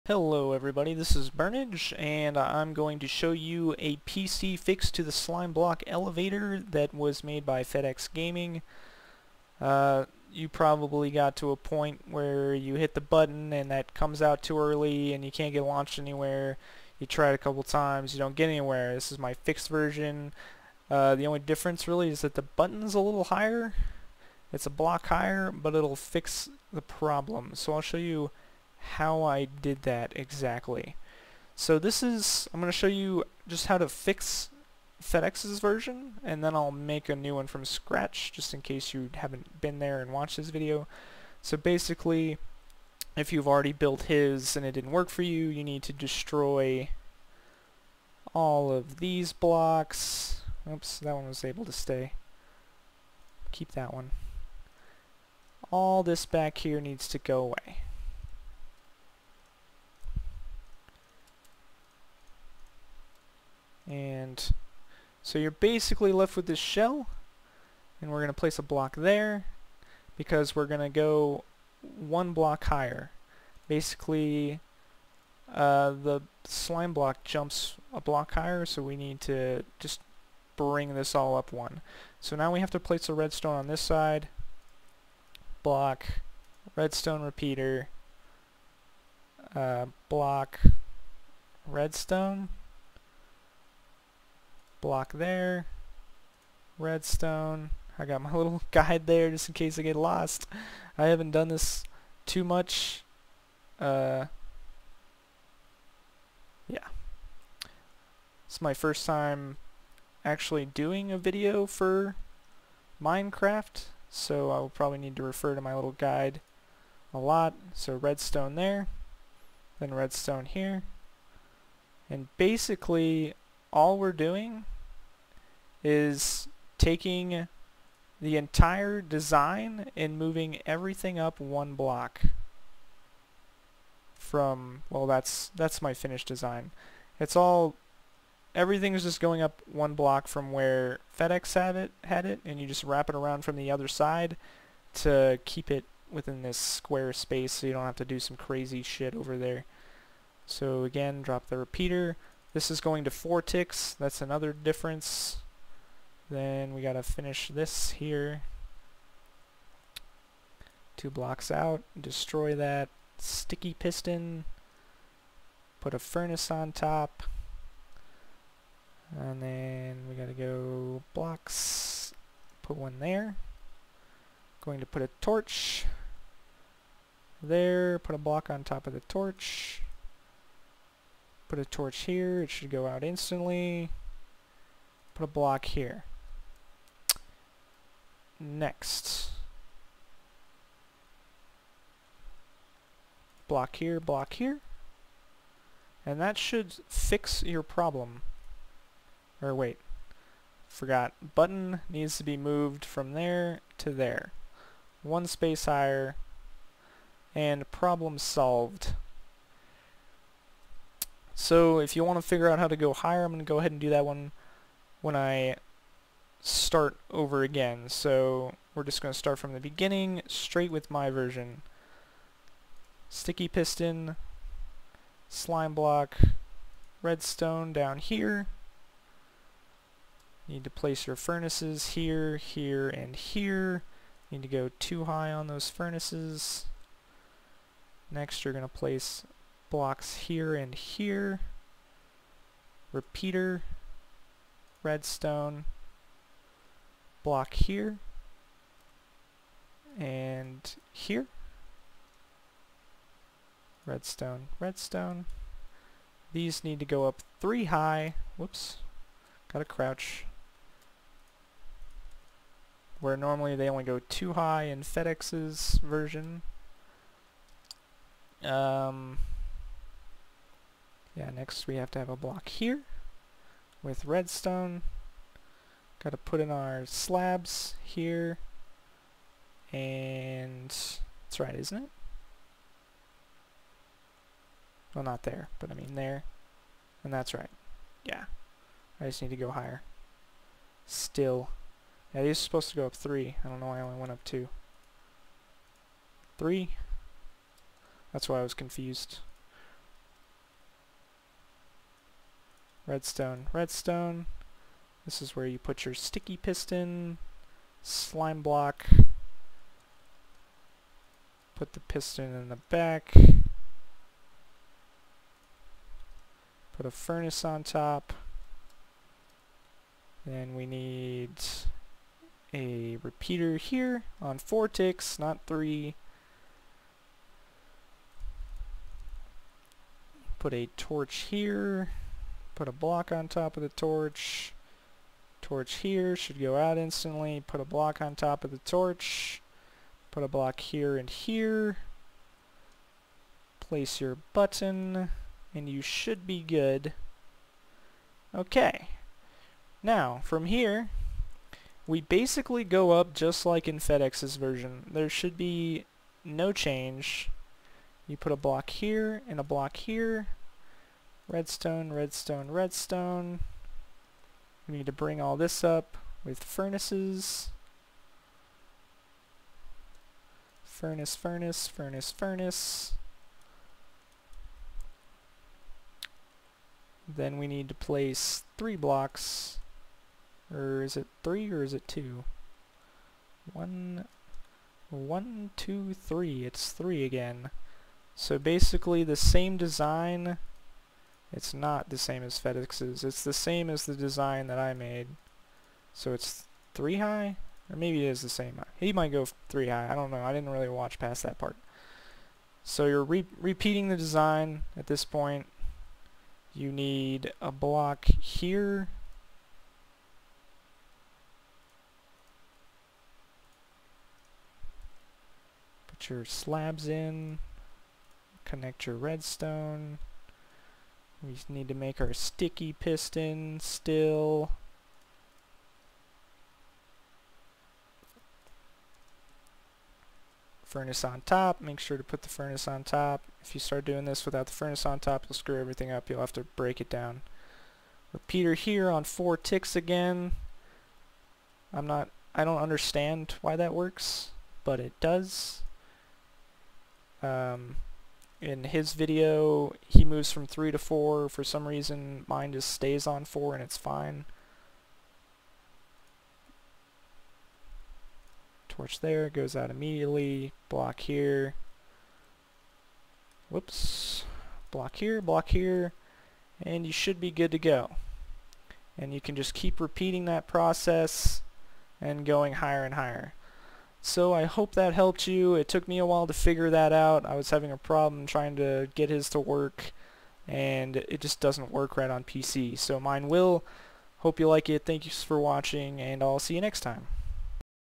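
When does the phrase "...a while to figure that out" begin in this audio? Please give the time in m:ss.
7:55.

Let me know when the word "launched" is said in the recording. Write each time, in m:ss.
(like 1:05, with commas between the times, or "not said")
0:15.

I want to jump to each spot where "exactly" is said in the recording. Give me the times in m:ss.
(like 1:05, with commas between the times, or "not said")
0:30.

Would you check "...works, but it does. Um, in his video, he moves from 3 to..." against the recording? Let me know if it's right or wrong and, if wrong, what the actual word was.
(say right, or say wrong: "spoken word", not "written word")
right.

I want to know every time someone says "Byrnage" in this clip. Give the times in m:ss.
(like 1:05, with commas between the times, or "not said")
0:01.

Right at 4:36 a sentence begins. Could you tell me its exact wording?
Got to put in our slabs here.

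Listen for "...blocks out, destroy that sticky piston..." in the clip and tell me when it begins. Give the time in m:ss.
2:41.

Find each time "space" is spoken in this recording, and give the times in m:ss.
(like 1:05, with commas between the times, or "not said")
2:27, 3:25.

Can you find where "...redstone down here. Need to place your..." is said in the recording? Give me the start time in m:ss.
3:47.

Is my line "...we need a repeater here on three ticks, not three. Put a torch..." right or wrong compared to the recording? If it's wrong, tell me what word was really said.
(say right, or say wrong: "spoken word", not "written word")
wrong: "four", not "three".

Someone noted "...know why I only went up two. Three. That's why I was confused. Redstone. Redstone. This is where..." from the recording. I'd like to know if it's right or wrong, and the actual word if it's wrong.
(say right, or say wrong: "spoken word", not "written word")
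right.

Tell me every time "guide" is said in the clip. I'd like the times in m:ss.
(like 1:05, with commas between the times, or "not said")
1:38, 1:55.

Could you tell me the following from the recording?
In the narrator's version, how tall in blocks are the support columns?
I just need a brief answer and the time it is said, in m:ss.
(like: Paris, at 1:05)
3, at 4:17.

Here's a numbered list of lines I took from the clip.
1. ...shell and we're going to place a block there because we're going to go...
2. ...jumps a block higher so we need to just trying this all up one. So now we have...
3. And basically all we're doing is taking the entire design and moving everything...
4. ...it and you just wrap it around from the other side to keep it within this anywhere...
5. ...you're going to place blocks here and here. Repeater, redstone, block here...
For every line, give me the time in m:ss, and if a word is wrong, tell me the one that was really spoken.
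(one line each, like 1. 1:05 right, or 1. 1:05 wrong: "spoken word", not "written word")
1. 1:06 right
2. 1:17 wrong: "bring", not "trying"
3. 2:02 right
4. 2:22 wrong: "square", not "anywhere"
5. 3:58 right.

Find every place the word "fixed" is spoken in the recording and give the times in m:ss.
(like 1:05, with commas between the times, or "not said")
0:04, 0:19.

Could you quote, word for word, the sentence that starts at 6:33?
It's the same as the design that I made.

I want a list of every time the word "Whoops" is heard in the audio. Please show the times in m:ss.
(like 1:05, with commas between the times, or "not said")
4:18, 7:43.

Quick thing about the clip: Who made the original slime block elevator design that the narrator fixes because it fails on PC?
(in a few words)
Fed X Gaming.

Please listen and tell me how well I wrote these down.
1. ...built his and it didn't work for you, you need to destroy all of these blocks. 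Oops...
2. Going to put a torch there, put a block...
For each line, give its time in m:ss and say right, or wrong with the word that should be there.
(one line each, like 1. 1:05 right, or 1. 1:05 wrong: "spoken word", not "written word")
1. 0:43 right
2. 2:54 right.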